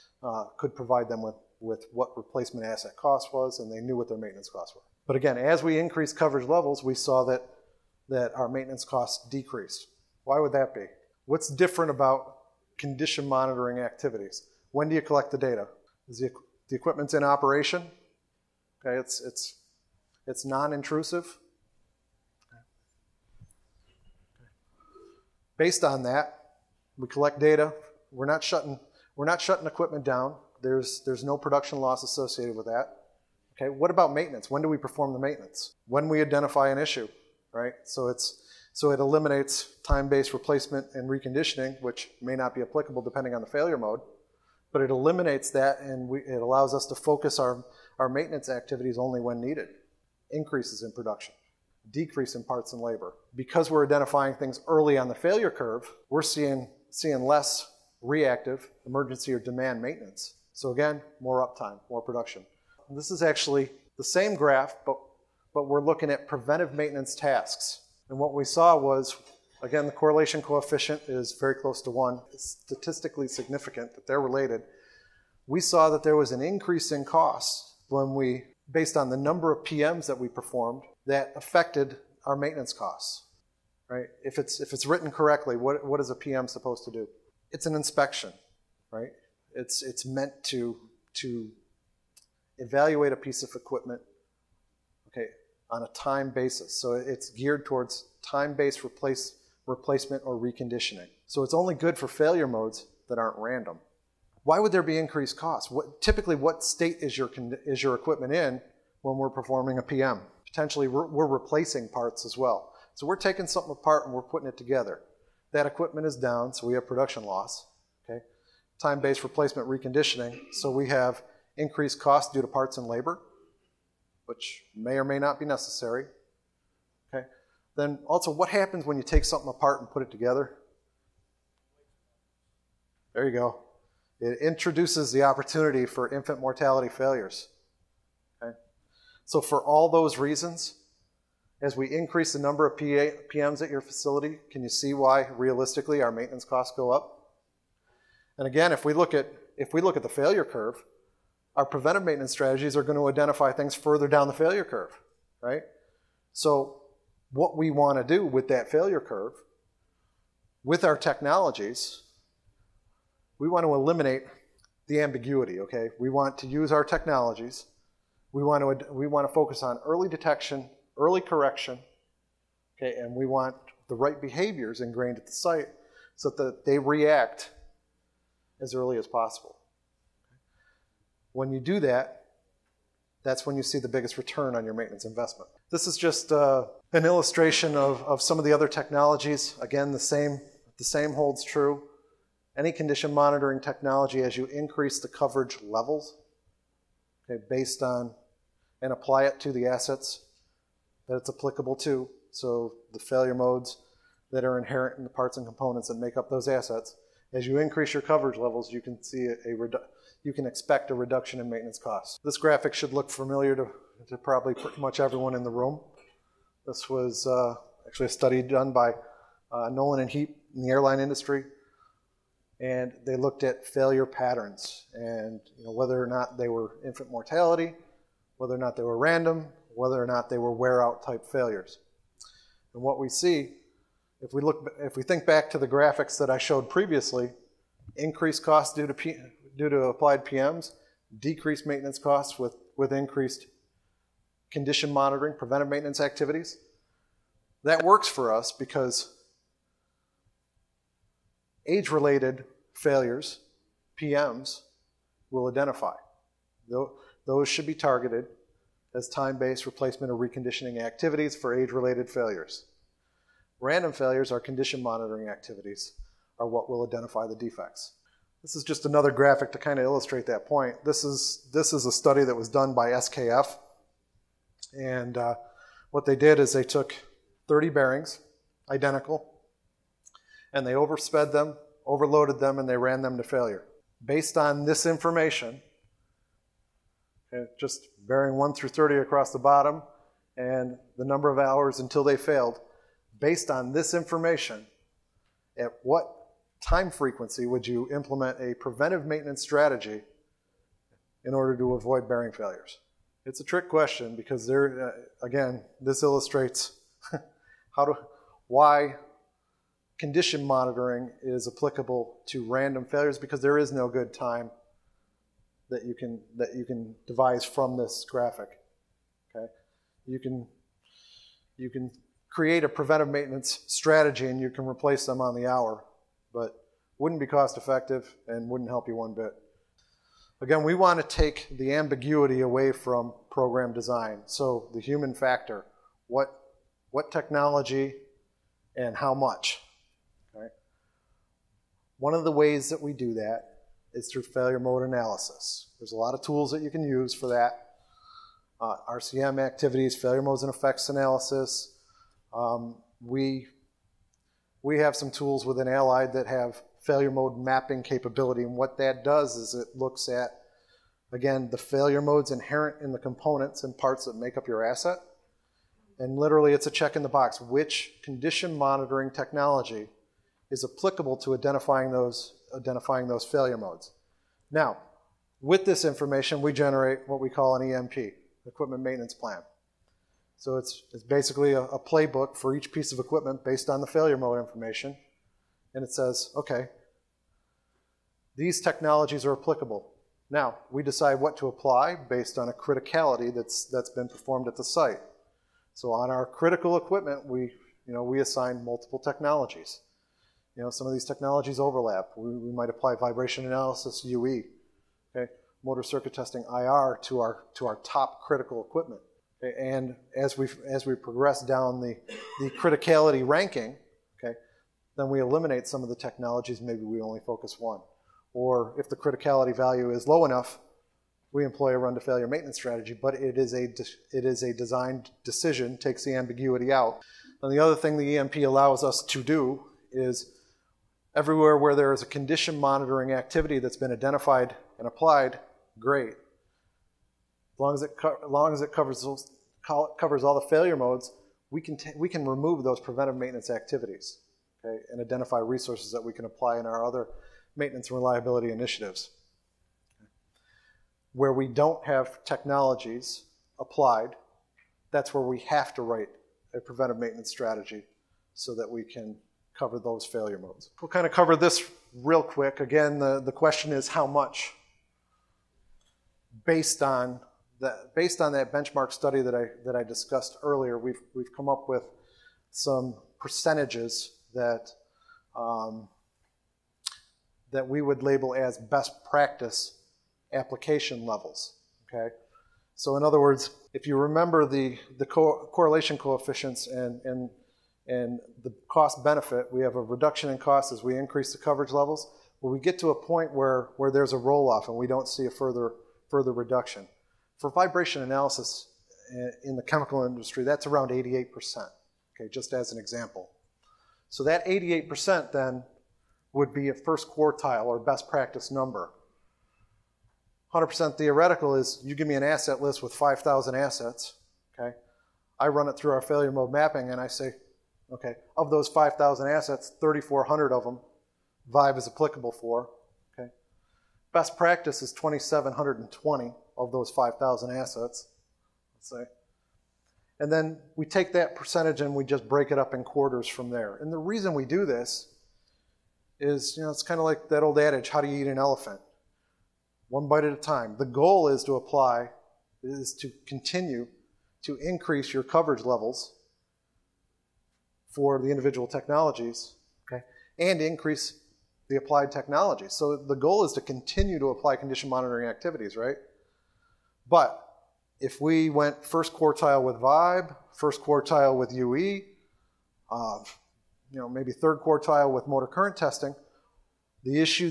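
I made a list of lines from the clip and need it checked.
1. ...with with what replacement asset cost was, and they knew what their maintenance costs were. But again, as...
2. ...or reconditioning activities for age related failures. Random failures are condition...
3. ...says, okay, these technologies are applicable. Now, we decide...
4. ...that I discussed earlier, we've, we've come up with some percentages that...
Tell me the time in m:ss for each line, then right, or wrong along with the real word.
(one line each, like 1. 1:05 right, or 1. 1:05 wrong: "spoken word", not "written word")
1. 0:01 right
2. 4:20 right
3. 6:25 right
4. 7:49 right.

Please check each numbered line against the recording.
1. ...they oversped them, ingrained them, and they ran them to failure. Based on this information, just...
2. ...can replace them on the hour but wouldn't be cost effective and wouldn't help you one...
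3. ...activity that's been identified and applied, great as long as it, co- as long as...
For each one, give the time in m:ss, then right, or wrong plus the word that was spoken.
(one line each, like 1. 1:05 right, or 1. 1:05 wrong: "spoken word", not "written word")
1. 4:40 wrong: "overloaded", not "ingrained"
2. 5:24 right
3. 7:13 right.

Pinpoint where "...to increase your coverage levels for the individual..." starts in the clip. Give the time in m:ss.
9:04.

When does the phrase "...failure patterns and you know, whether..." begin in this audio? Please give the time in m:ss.
3:43.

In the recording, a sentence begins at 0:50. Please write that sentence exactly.
Increases in production, decrease in parts and labor.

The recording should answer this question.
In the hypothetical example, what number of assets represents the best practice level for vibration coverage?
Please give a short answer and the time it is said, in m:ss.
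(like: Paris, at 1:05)
2,720, at 8:44.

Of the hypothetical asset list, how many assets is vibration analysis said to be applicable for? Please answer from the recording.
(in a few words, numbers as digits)
3,400.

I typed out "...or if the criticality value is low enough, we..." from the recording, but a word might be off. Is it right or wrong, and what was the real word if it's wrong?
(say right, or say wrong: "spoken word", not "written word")
right.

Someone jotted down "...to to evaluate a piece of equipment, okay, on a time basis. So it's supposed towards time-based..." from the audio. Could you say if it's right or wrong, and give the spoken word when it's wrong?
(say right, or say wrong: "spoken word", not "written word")
wrong: "geared", not "supposed".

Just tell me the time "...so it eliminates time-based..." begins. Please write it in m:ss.
0:38.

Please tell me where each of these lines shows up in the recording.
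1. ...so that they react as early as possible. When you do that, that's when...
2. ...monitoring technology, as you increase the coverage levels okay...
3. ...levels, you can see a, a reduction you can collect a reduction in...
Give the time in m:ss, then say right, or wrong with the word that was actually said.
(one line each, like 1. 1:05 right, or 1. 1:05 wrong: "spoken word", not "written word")
1. 2:56 right
2. 3:13 right
3. 3:28 wrong: "expect", not "collect".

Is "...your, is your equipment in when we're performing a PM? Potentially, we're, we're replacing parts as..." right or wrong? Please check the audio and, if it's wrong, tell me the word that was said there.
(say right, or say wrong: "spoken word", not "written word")
right.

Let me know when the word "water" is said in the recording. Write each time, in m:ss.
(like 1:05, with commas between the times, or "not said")
not said.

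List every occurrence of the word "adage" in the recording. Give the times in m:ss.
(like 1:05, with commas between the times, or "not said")
8:57.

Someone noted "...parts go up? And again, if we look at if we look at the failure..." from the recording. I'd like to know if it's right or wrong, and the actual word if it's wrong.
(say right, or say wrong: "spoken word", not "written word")
wrong: "costs", not "parts".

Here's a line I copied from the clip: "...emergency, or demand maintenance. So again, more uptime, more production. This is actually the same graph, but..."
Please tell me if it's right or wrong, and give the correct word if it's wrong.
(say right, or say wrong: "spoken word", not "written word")
right.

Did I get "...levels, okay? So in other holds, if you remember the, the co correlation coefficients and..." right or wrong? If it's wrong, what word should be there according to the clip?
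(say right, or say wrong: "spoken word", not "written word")
wrong: "words", not "holds".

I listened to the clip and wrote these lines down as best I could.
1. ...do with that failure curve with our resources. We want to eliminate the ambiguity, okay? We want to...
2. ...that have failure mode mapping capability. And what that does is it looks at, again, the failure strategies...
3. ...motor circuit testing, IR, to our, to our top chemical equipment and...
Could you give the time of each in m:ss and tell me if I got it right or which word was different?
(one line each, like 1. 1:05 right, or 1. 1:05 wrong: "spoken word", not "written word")
1. 2:38 wrong: "technologies", not "resources"
2. 5:56 wrong: "modes", not "strategies"
3. 6:45 wrong: "critical", not "chemical".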